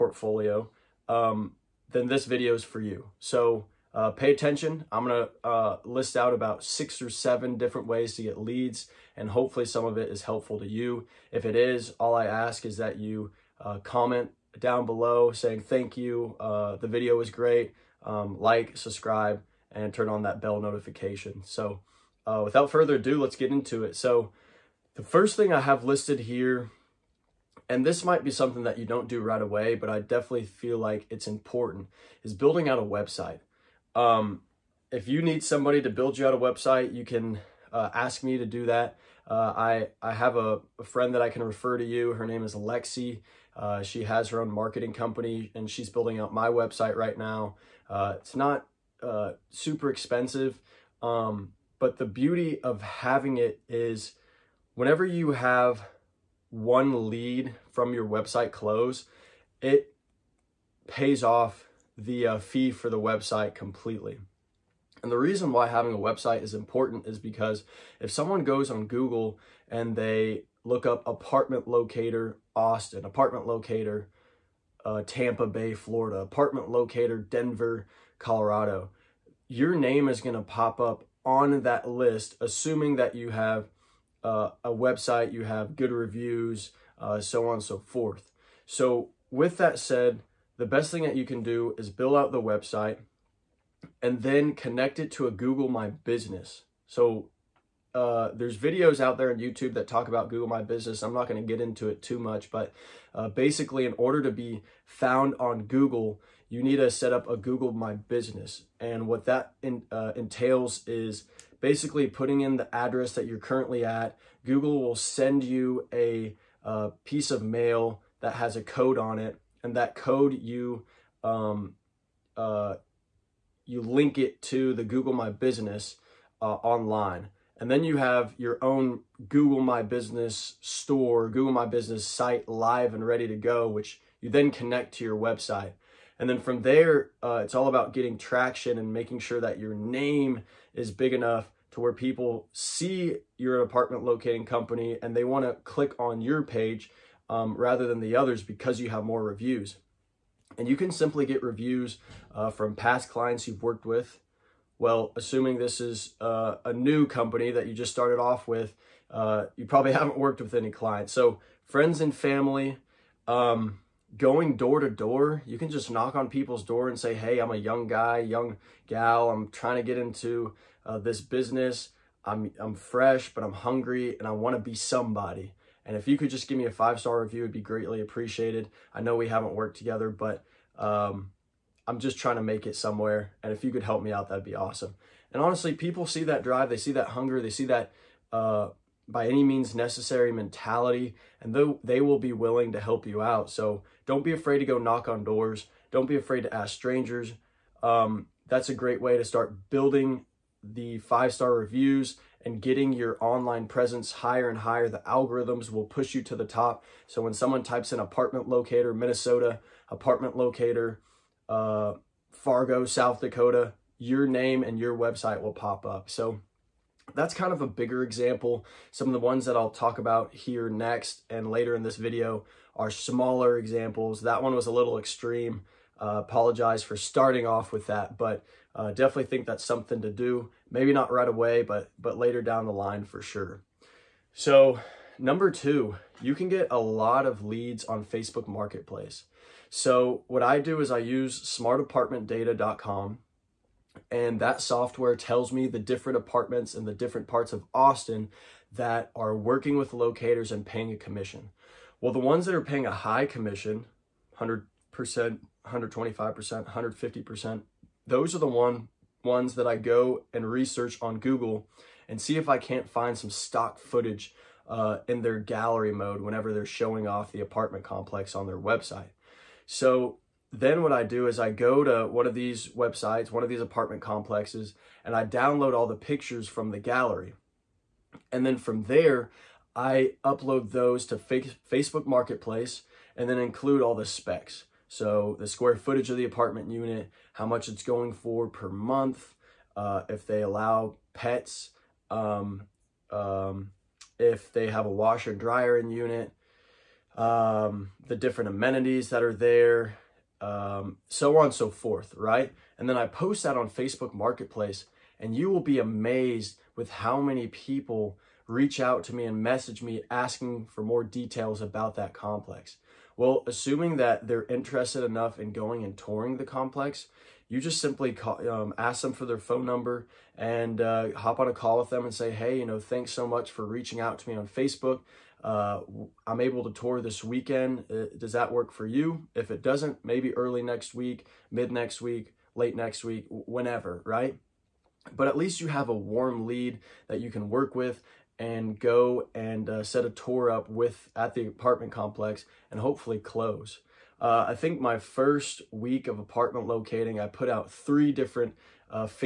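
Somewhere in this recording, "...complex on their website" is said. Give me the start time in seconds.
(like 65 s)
267 s.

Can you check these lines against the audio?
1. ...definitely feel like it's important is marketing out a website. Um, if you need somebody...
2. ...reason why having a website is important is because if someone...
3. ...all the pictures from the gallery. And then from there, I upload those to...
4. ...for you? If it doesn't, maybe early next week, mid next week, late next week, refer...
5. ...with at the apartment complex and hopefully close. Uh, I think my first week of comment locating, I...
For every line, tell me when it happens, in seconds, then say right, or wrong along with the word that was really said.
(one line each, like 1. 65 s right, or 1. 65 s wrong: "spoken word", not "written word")
1. 30 s wrong: "building", not "marketing"
2. 65 s right
3. 275 s right
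4. 328 s wrong: "whenever", not "refer"
5. 340 s wrong: "apartment", not "comment".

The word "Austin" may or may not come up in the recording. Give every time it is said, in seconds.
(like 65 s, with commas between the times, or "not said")
72 s, 247 s.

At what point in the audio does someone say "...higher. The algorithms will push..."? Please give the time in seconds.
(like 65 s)
204 s.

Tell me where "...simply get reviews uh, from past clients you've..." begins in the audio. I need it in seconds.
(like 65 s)
150 s.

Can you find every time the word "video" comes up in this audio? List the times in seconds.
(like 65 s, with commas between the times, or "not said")
2 s, 16 s, 98 s, 221 s.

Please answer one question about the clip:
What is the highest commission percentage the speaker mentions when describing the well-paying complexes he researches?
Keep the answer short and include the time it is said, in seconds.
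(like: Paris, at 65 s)
150%, at 255 s.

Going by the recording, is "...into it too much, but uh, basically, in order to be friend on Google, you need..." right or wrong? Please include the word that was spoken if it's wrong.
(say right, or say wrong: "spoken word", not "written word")
wrong: "found", not "friend".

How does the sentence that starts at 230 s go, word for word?
Maybe not right away, but, but later down the line for sure.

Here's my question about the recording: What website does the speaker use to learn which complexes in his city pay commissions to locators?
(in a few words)
smartapartmentdata.com.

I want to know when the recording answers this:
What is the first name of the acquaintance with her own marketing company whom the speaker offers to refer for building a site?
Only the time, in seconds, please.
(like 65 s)
42 s.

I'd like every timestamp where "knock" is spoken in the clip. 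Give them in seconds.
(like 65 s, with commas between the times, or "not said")
165 s, 194 s.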